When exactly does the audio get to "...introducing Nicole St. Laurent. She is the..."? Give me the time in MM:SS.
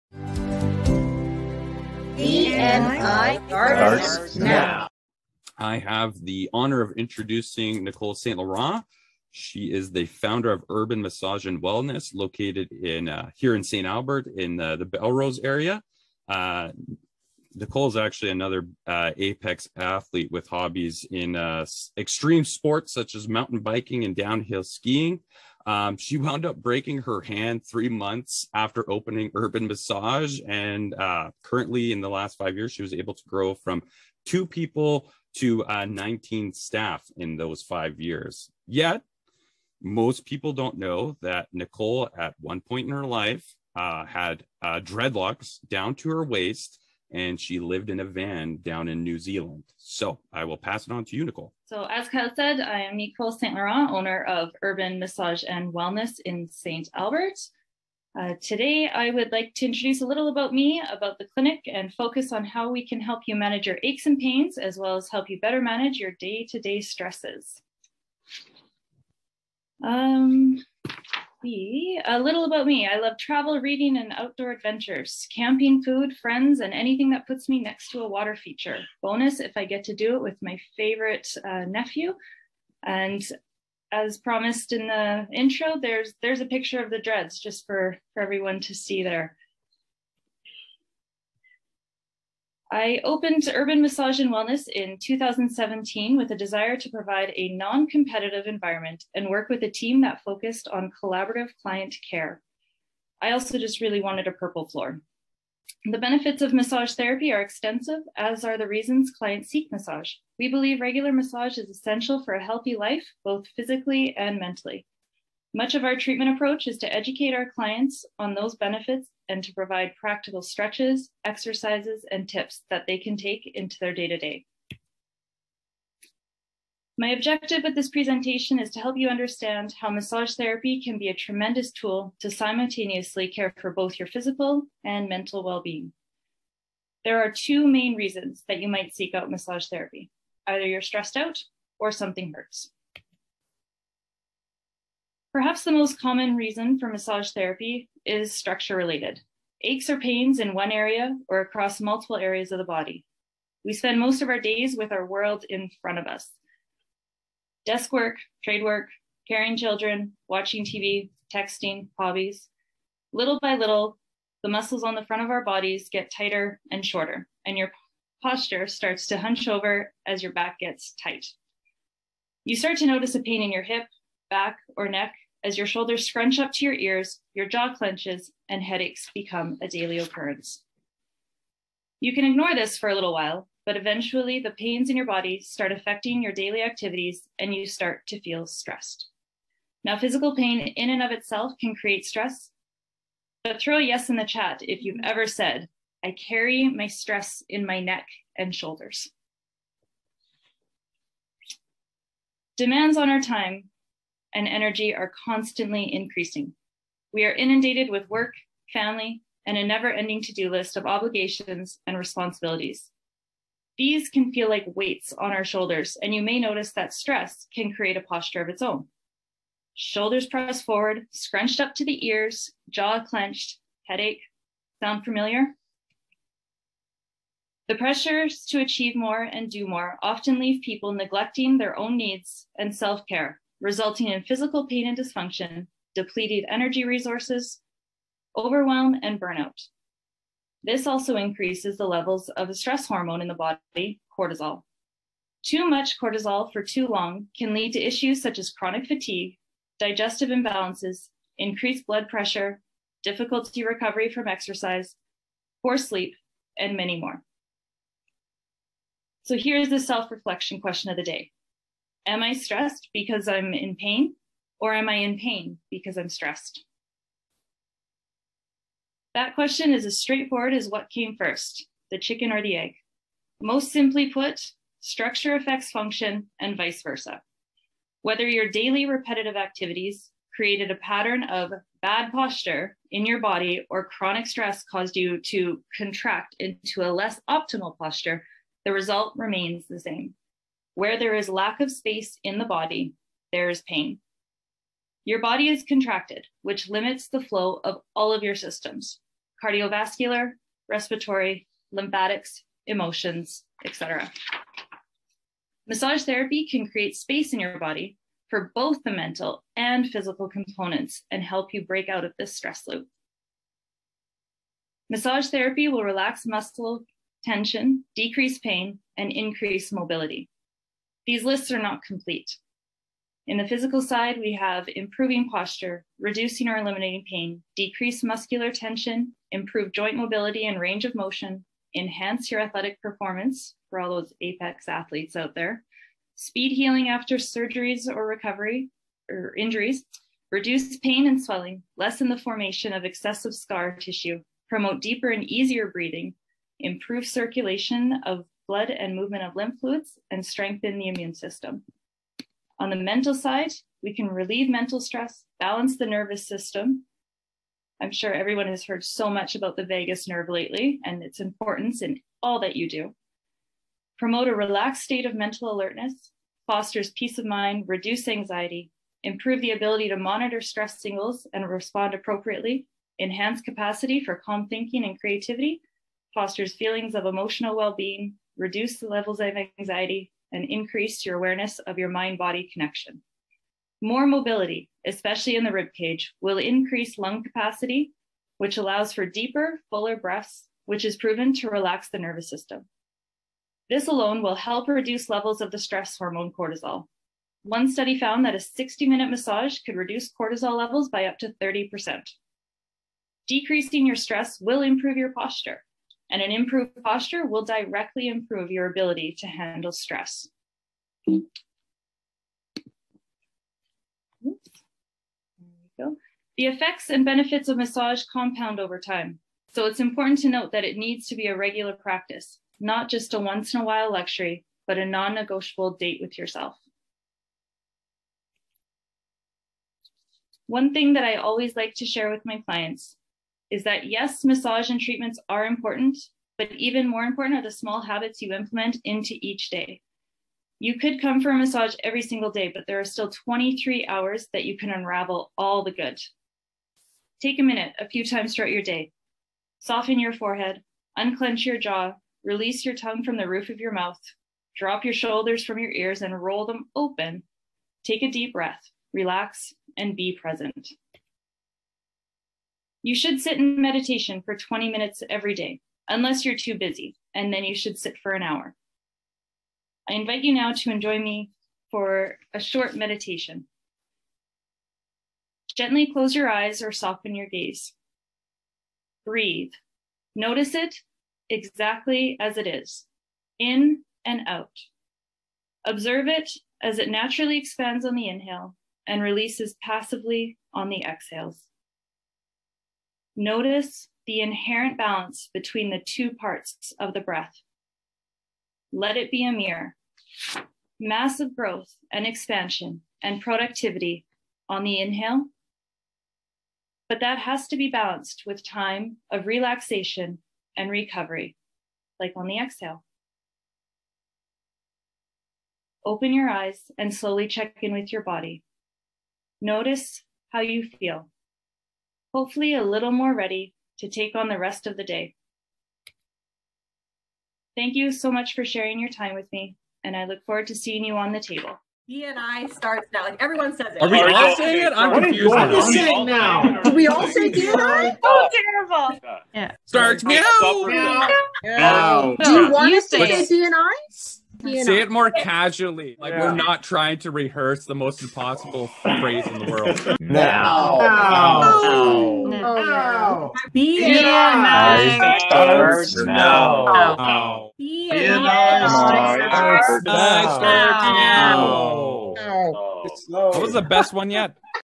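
00:06.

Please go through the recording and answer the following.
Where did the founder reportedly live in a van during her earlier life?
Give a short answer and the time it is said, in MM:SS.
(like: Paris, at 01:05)
New Zealand, at 00:49.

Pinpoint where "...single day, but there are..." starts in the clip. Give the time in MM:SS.
07:22.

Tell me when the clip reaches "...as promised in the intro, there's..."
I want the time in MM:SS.
01:23.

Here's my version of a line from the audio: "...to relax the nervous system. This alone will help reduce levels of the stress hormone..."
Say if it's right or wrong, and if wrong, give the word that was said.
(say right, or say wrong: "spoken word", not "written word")
right.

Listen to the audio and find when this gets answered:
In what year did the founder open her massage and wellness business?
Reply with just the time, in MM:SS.
01:34.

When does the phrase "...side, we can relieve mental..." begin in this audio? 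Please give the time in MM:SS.
05:53.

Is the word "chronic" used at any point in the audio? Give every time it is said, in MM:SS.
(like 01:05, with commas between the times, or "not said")
04:08, 04:43.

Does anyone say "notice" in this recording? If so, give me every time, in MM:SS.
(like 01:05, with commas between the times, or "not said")
02:52, 03:36, 08:00, 08:13, 08:39.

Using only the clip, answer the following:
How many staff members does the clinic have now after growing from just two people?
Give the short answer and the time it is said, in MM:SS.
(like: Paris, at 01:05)
19, at 00:35.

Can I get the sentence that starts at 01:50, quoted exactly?
We believe regular massage is essential for a healthy life, both physically and mentally.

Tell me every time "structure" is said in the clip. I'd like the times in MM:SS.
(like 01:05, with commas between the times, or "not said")
02:28, 04:34.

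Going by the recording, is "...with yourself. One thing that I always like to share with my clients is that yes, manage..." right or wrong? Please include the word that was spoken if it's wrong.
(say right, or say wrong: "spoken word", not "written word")
wrong: "massage", not "manage".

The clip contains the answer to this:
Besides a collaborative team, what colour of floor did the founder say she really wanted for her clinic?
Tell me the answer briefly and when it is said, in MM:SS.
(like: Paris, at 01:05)
Purple, at 01:44.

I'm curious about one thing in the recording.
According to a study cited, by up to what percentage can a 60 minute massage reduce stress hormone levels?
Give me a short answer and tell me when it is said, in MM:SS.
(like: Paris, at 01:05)
30%, at 06:41.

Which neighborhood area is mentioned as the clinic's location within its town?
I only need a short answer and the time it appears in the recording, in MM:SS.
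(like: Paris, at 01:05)
Belrose, at 00:14.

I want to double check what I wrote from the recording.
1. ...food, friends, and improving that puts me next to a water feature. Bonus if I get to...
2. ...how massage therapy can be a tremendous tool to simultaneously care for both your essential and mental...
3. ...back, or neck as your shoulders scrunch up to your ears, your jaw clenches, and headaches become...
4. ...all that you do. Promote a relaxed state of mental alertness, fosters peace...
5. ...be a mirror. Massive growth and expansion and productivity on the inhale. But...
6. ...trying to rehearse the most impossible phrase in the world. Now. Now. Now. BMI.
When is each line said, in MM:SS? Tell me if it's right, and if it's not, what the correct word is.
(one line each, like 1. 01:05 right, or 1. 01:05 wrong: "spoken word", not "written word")
1. 01:15 wrong: "anything", not "improving"
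2. 02:09 wrong: "physical", not "essential"
3. 02:54 right
4. 06:02 right
5. 08:19 right
6. 09:06 right.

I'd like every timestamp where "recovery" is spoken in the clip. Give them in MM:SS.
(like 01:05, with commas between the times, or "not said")
04:13, 05:38, 08:30.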